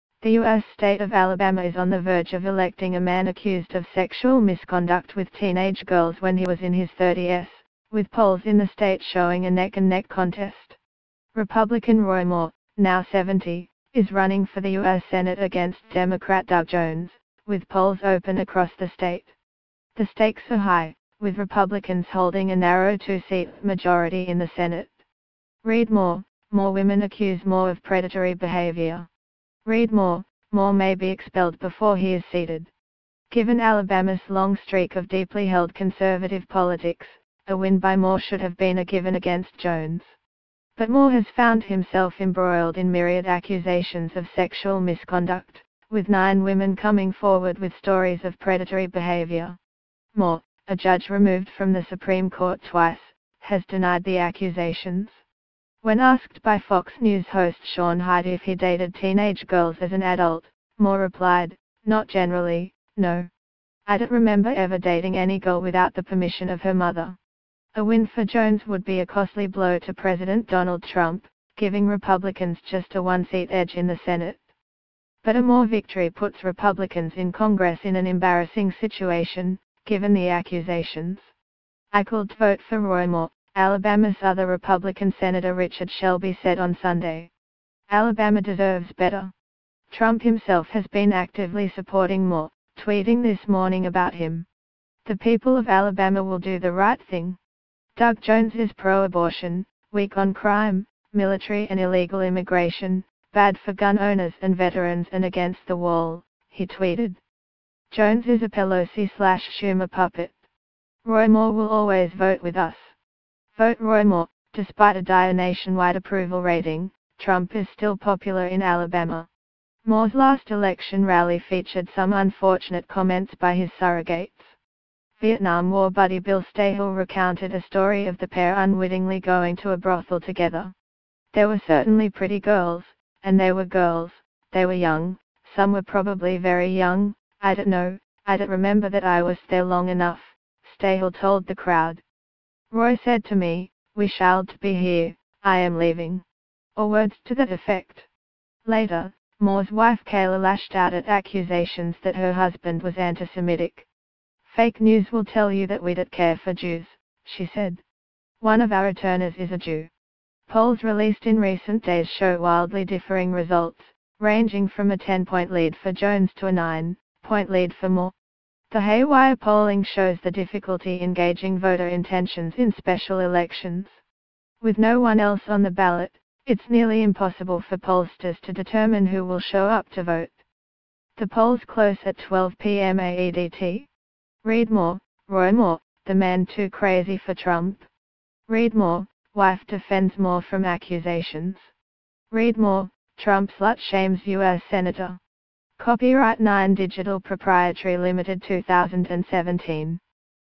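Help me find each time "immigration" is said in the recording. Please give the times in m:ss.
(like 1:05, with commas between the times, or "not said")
1:42.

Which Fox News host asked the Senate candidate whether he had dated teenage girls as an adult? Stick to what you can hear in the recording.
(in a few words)
Sean Hyde.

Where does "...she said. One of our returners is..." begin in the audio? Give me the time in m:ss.
2:37.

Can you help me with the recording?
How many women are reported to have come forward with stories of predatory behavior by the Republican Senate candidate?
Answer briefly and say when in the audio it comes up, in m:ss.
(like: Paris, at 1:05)
9, at 0:46.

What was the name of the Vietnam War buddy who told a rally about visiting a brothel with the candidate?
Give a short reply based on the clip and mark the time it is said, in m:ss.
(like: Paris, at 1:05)
Bill Staehle, at 2:06.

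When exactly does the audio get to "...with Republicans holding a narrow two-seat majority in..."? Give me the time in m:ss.
0:21.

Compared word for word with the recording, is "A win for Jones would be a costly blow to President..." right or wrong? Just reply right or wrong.
right.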